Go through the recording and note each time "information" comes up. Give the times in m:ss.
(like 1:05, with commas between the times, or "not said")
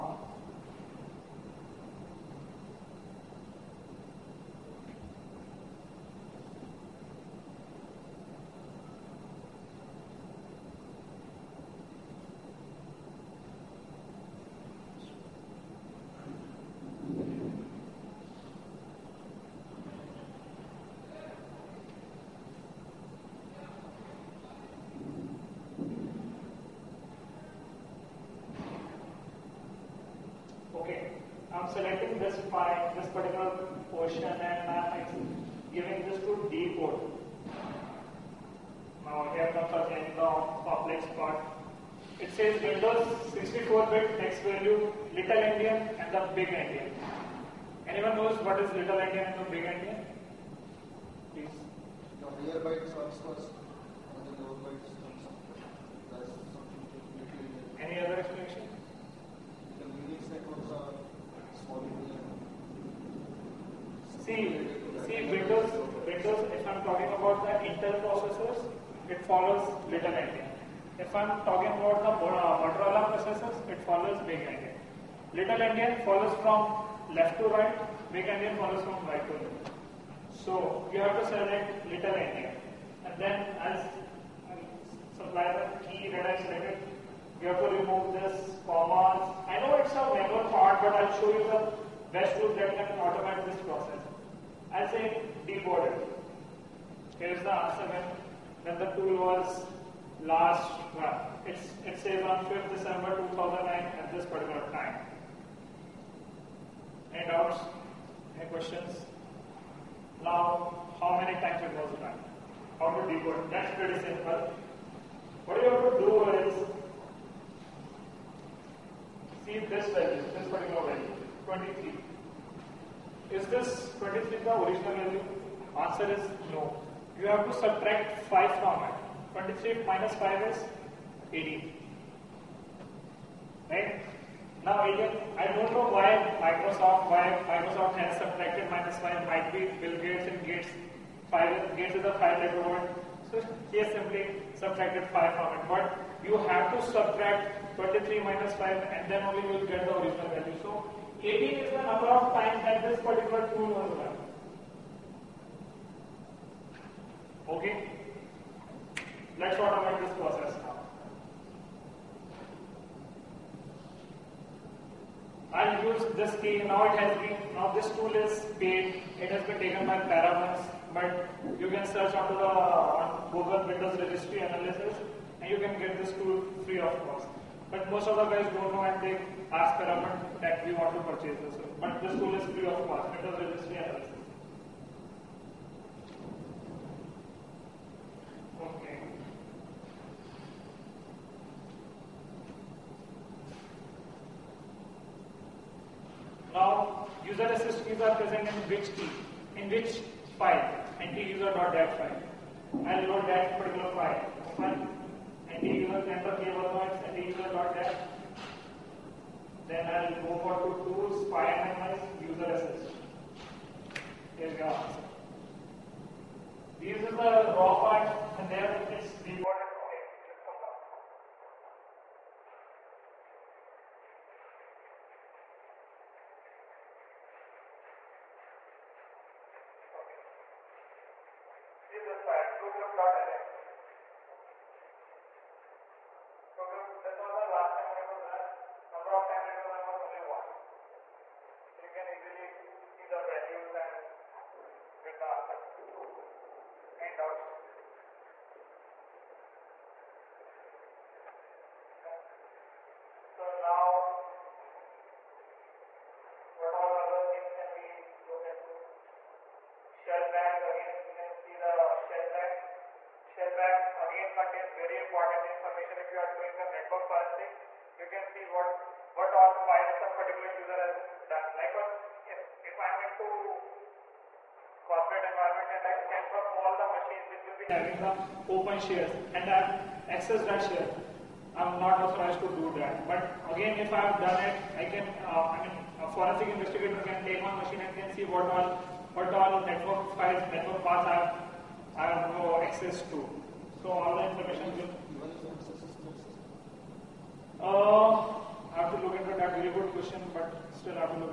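4:25, 4:54.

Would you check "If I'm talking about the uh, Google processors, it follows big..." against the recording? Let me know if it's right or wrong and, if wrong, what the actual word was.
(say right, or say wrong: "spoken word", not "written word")
wrong: "Motorola", not "Google".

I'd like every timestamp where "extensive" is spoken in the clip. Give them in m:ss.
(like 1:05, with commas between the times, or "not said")
not said.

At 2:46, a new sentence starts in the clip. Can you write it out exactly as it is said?
Now it has been, now this tool is paid.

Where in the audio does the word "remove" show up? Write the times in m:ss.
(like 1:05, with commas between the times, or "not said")
1:27.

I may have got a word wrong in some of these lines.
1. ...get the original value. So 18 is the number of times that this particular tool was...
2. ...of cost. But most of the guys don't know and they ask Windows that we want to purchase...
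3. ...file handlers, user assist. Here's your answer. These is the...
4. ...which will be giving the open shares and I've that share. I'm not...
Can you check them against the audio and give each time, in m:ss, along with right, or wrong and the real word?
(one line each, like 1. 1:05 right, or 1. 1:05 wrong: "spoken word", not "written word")
1. 2:29 right
2. 2:56 wrong: "Paramount", not "Windows"
3. 3:31 right
4. 4:37 wrong: "having", not "giving".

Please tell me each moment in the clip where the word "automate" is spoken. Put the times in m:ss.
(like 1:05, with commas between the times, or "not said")
1:33, 2:39.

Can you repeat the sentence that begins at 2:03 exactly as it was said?
Is this 23 the original value?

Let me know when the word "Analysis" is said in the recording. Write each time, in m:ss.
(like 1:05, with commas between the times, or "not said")
2:54, 3:03.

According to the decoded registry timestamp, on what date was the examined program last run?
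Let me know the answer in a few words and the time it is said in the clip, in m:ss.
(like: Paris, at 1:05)
5 December 2009, at 1:42.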